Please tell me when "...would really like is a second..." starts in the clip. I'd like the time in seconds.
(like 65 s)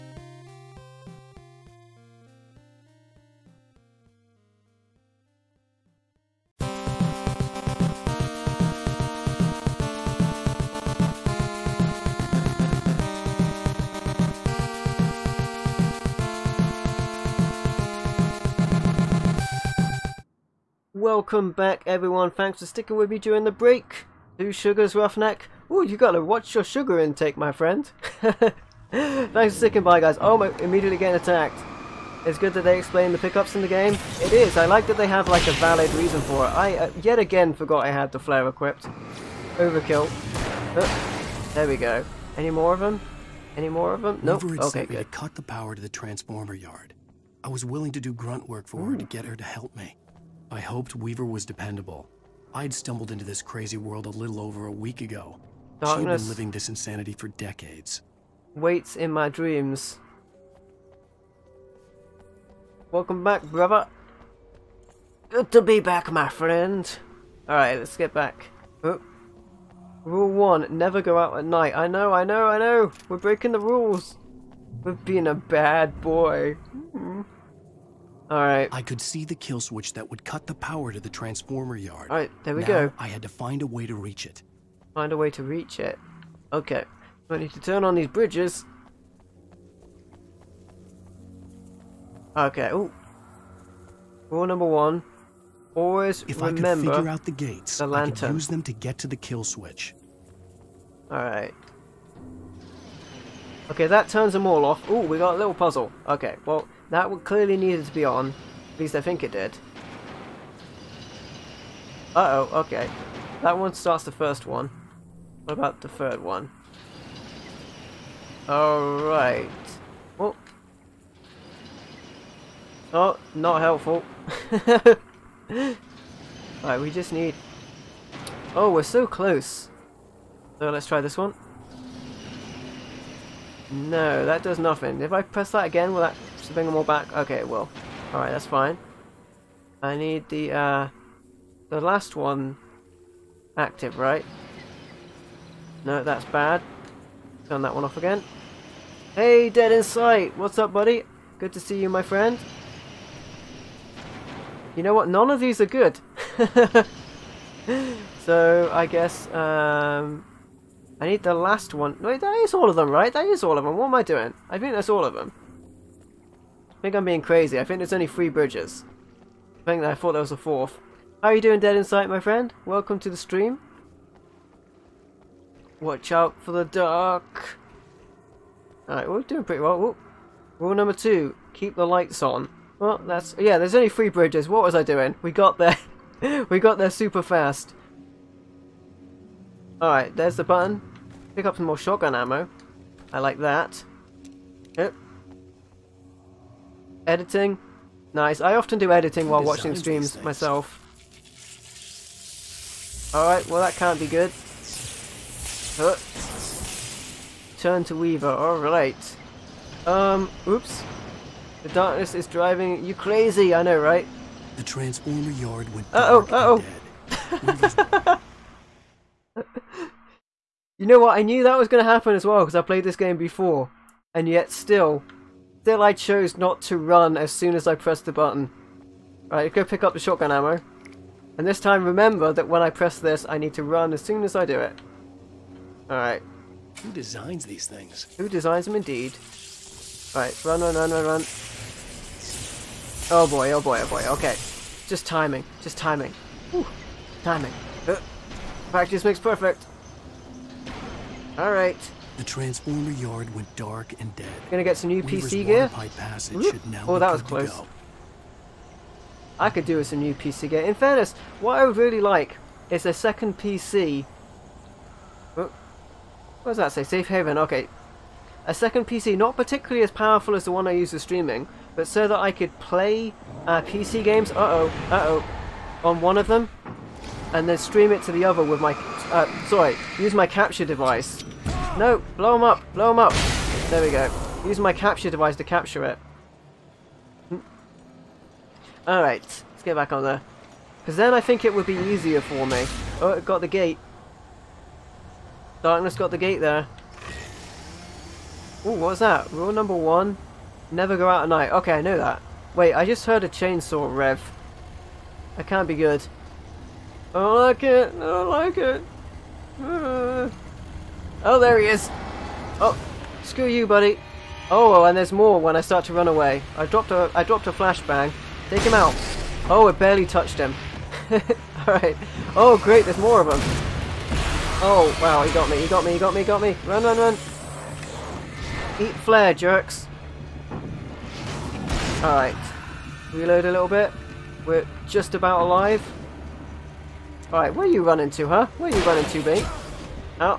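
261 s.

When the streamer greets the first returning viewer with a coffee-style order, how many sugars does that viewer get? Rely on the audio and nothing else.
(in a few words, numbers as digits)
2.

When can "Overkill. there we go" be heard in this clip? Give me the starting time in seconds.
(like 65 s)
39 s.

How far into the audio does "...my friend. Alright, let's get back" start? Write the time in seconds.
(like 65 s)
66 s.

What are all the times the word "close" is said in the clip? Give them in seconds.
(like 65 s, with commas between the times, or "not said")
129 s, 257 s.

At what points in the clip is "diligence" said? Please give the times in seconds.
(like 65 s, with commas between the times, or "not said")
not said.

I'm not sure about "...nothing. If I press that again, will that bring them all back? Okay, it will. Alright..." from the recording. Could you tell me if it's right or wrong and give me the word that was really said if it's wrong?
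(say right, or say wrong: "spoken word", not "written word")
right.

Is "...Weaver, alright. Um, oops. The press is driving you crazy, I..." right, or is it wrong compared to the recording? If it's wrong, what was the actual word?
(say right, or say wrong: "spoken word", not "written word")
wrong: "darkness", not "press".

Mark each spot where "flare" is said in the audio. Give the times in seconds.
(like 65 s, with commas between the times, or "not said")
38 s, 328 s.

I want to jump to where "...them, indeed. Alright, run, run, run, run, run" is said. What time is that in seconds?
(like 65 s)
238 s.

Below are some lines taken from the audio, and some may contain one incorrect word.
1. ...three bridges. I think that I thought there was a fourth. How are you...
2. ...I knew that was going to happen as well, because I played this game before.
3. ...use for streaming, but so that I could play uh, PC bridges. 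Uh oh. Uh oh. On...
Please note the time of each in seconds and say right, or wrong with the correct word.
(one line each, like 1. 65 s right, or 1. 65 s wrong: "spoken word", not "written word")
1. 168 s right
2. 221 s right
3. 270 s wrong: "games", not "bridges".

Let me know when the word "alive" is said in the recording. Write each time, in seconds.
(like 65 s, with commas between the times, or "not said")
335 s.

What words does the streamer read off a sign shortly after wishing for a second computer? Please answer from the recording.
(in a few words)
Safe haven.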